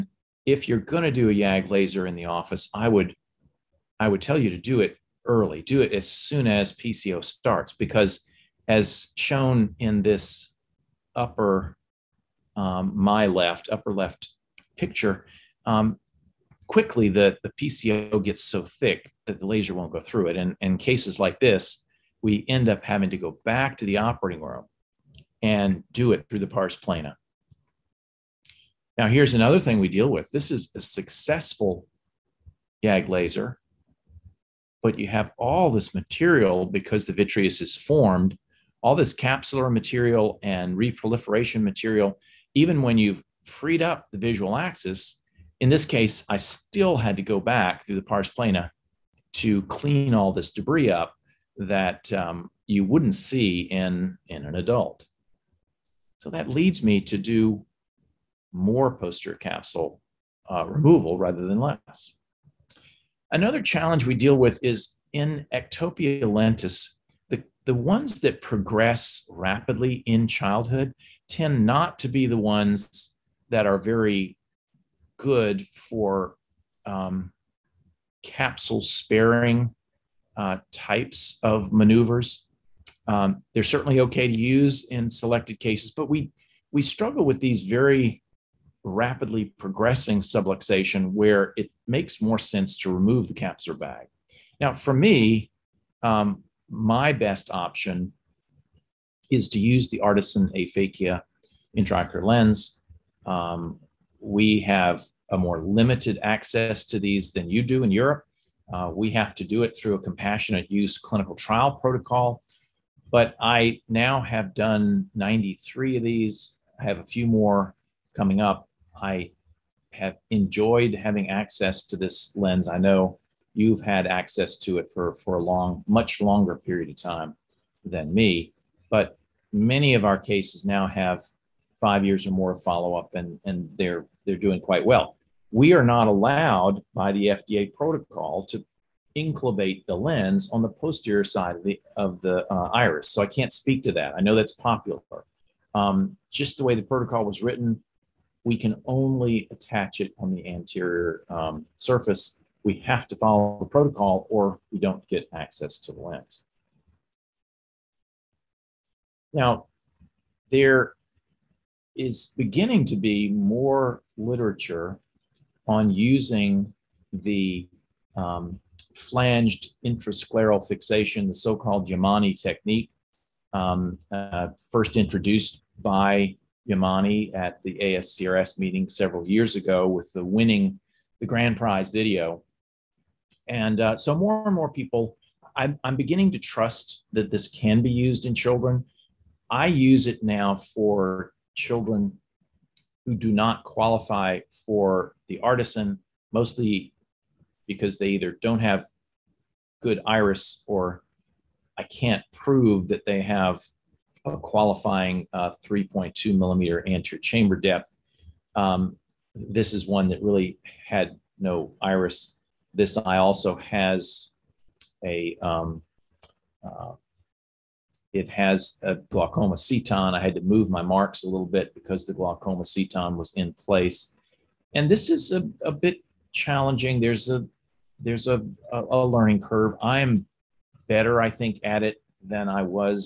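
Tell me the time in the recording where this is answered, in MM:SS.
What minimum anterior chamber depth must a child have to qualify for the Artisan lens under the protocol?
03:25.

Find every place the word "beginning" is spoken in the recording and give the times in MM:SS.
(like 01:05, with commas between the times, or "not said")
02:42, 03:05.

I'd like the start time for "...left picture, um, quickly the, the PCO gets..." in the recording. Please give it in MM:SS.
00:13.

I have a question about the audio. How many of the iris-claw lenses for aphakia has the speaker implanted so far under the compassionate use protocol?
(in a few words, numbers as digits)
93.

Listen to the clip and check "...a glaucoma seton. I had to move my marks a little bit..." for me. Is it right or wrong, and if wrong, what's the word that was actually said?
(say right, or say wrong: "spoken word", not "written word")
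right.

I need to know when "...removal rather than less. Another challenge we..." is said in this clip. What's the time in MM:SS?
01:00.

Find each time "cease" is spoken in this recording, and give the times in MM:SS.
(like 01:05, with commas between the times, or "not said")
not said.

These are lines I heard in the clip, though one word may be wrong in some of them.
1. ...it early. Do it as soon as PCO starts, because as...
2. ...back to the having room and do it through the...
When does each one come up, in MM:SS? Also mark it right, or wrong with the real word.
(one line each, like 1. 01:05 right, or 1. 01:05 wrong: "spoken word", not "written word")
1. 00:04 right
2. 00:23 wrong: "operating", not "having".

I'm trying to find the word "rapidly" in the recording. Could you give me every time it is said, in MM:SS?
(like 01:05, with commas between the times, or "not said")
01:09, 01:28.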